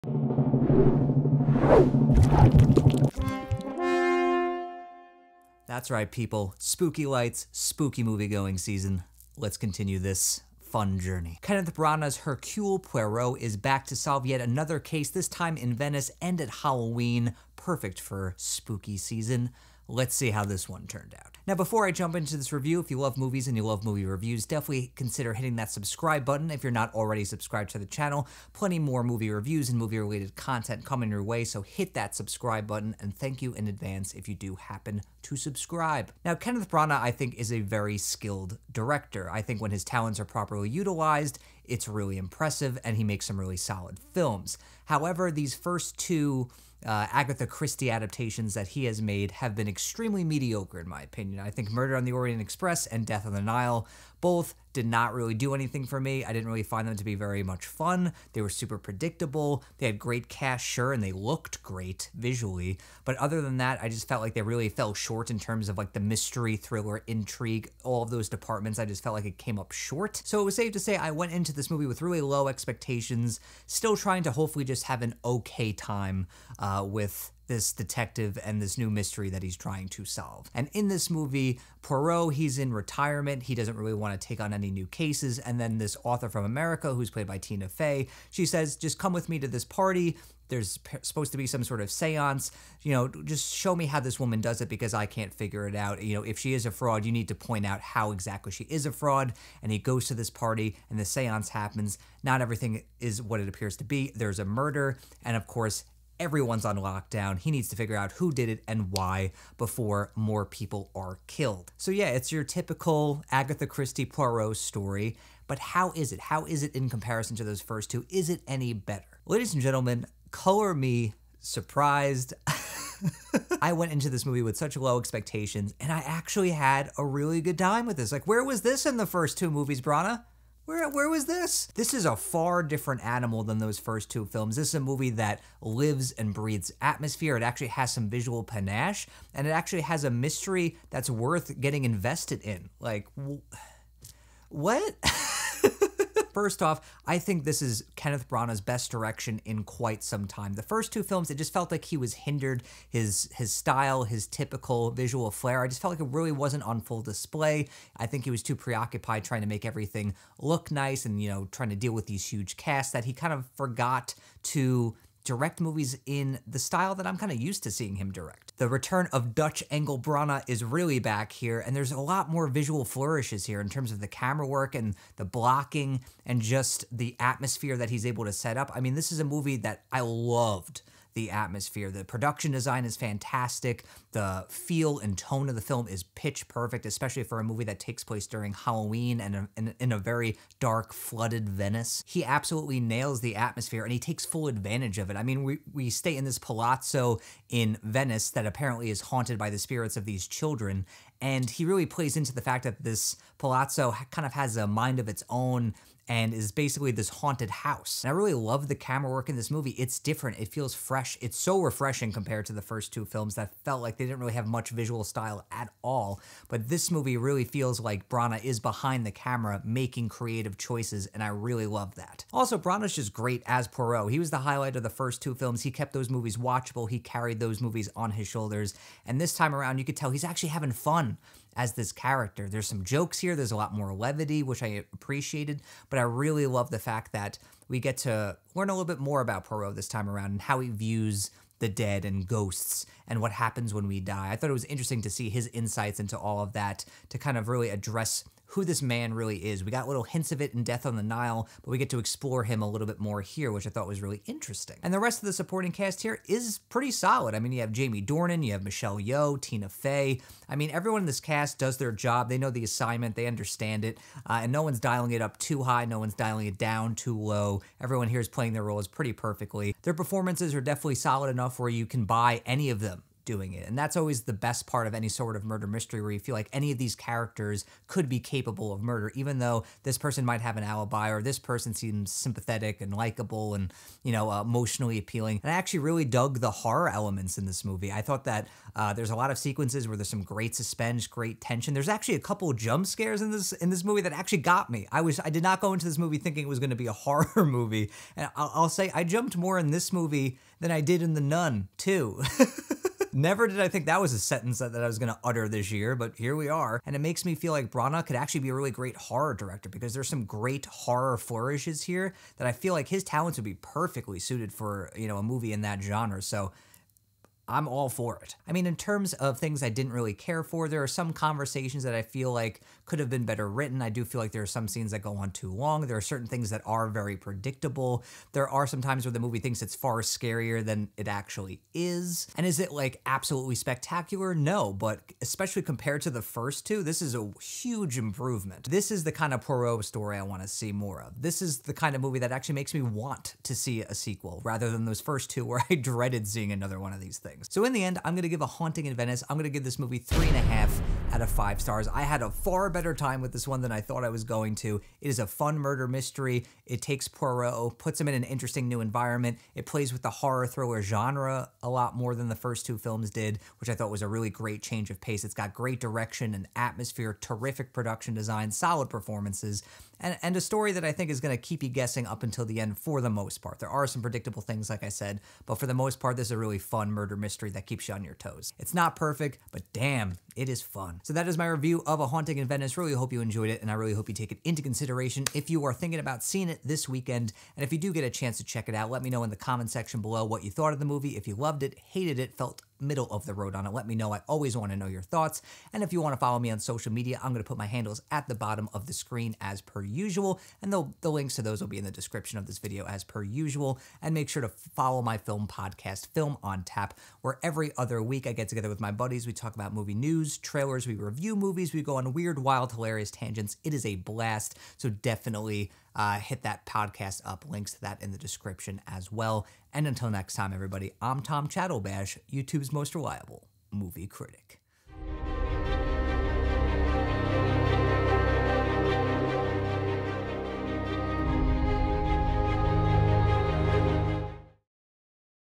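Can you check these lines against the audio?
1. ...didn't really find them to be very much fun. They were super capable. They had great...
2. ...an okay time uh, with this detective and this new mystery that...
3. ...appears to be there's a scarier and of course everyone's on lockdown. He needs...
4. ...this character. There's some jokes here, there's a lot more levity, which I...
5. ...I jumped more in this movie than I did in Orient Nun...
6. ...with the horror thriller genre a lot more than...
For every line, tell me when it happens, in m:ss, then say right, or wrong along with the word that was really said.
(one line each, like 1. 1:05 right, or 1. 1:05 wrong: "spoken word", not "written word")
1. 0:56 wrong: "predictable", not "capable"
2. 1:15 right
3. 1:43 wrong: "murder", not "scarier"
4. 3:51 right
5. 4:58 wrong: "The", not "Orient"
6. 5:59 right.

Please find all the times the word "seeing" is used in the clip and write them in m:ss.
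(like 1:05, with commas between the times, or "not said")
2:47, 5:46, 6:26.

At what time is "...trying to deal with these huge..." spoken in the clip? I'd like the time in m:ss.
2:41.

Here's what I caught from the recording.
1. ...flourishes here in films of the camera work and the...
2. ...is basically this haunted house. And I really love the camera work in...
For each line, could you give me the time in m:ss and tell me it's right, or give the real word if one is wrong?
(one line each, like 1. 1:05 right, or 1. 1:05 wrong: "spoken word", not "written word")
1. 2:52 wrong: "terms", not "films"
2. 3:26 right.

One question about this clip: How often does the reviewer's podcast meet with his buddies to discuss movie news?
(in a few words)
every other week.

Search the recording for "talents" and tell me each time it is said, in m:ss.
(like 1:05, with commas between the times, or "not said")
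0:39, 5:13.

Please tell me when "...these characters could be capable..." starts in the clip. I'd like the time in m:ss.
4:36.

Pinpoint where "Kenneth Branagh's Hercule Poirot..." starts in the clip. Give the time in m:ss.
0:11.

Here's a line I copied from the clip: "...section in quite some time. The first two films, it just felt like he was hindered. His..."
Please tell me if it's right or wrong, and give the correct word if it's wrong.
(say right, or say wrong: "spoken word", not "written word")
wrong: "direction", not "section".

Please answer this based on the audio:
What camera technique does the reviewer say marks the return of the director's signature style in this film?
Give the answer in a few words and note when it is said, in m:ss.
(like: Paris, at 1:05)
Dutch angle, at 2:49.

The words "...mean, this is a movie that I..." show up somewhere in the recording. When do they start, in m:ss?
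2:58.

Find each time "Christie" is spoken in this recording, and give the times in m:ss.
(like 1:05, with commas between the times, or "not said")
0:47, 1:53.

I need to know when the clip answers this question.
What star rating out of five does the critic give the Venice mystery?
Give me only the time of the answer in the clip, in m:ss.
5:49.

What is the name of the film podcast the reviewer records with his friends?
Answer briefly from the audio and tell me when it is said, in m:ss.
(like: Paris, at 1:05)
Film on Tap, at 6:46.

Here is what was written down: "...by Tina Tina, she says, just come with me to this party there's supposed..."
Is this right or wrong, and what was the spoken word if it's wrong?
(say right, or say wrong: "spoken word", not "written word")
wrong: "Fey", not "Tina".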